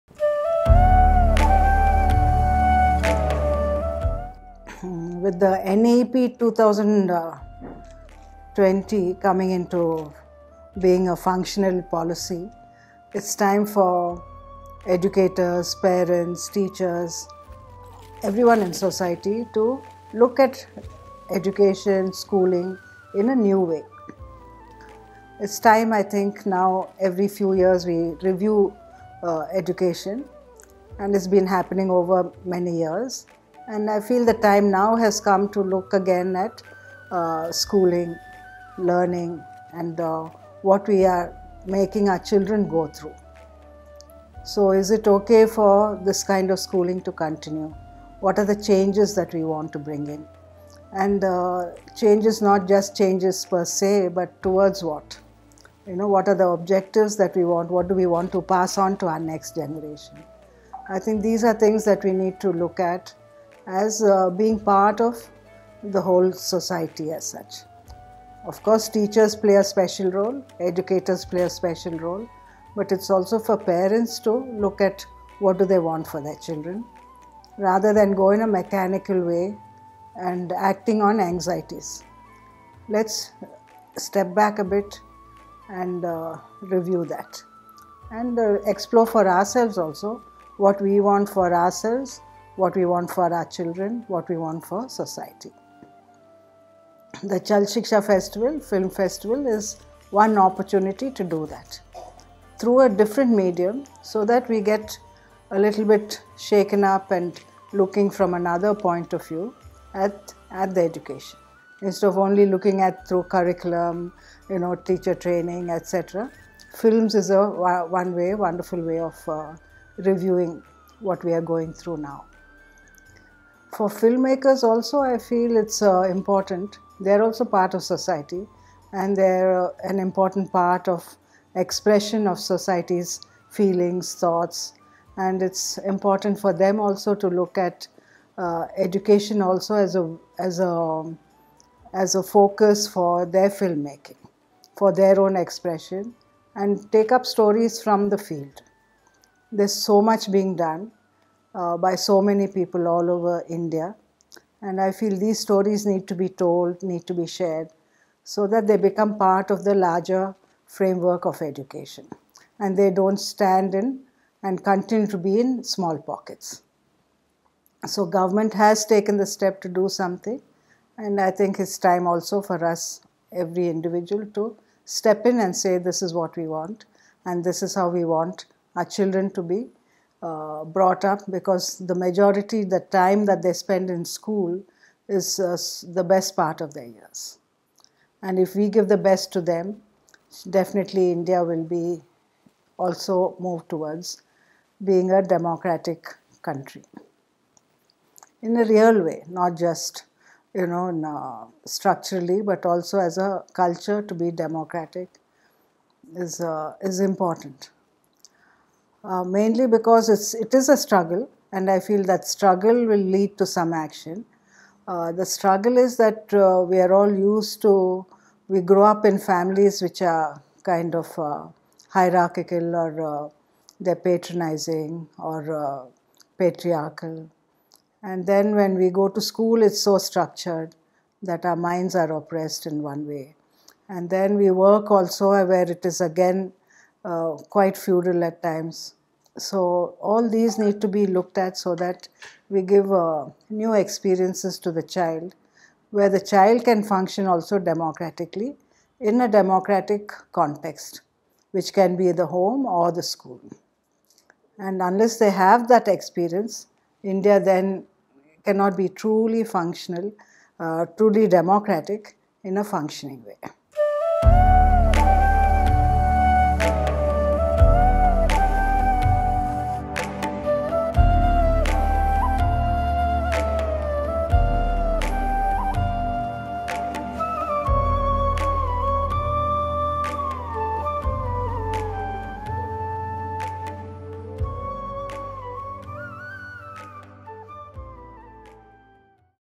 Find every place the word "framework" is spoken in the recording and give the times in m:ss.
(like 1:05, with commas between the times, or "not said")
2:40.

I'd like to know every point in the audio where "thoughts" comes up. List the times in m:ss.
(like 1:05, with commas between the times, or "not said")
2:14.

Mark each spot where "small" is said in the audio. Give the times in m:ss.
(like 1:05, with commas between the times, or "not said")
2:45.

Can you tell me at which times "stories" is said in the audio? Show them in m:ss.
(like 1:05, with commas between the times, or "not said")
2:27, 2:35.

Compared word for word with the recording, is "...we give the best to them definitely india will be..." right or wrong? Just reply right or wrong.
right.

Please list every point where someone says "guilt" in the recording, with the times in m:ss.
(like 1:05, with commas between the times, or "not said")
not said.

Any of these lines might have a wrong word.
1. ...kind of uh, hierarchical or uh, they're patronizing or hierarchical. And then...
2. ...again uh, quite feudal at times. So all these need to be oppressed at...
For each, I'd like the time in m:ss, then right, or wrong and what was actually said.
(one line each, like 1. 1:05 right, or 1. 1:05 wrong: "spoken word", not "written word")
1. 3:40 wrong: "patriarchal", not "hierarchical"
2. 3:56 wrong: "looked", not "oppressed".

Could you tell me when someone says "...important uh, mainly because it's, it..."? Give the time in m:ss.
3:26.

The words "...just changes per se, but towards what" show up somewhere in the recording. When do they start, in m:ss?
0:52.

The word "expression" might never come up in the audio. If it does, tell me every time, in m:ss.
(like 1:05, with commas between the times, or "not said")
2:11, 2:25.